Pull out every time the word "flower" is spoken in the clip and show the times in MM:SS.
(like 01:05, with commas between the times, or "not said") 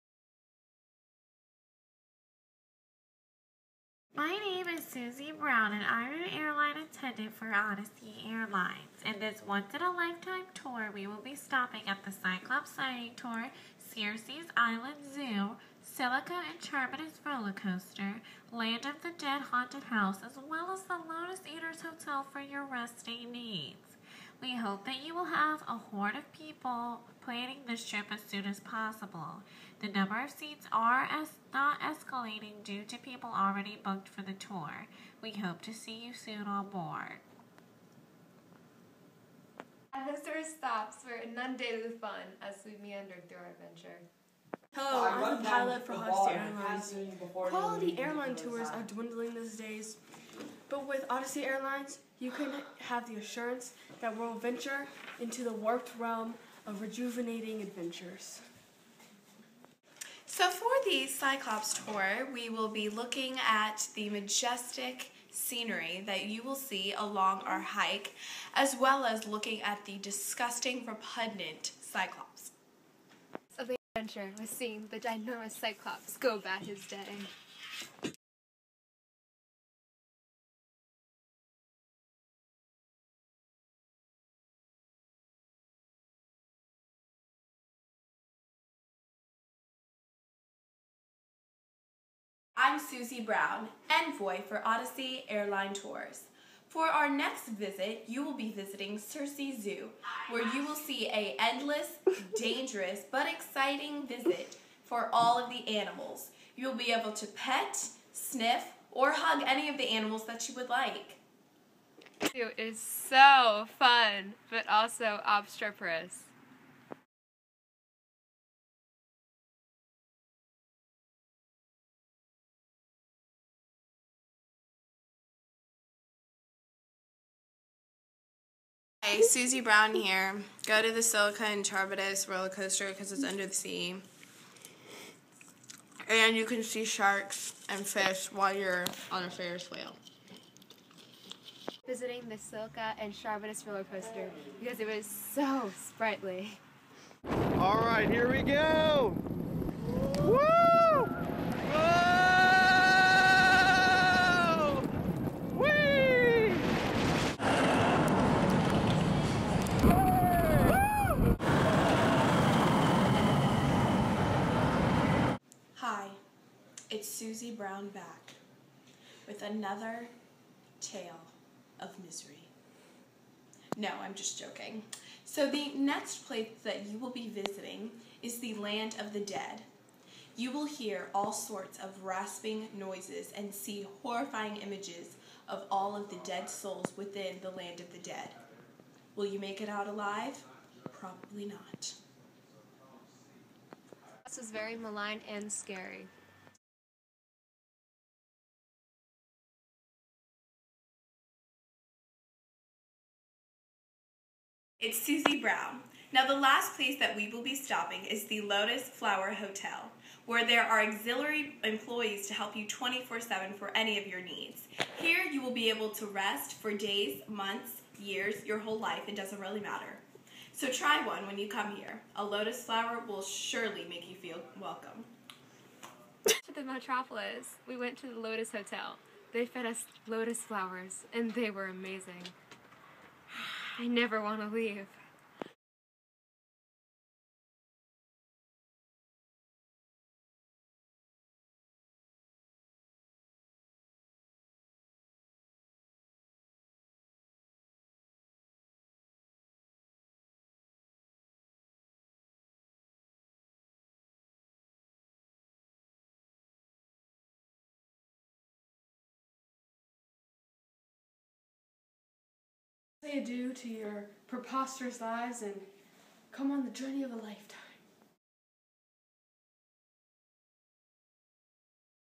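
03:28, 03:42, 03:50.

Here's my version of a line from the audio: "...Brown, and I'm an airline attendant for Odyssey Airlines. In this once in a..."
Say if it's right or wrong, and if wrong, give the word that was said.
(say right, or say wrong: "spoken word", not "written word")
right.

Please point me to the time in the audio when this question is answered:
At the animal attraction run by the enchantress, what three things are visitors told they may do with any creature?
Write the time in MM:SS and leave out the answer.
01:47.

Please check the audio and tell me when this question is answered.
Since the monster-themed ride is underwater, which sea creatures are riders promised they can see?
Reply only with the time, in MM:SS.
02:16.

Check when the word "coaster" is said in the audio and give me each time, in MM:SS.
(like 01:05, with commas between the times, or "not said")
00:17, 02:12, 02:23.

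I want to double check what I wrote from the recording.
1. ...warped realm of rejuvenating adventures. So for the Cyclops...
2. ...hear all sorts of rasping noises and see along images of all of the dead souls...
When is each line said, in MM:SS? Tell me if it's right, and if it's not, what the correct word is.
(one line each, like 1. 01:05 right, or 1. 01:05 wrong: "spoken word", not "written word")
1. 00:55 right
2. 03:00 wrong: "horrifying", not "along".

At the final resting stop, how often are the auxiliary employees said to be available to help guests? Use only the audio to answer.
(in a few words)
24/7.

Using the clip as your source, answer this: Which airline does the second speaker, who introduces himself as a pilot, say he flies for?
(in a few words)
Hofstra Airlines.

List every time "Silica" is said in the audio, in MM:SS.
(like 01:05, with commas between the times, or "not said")
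00:15, 02:22.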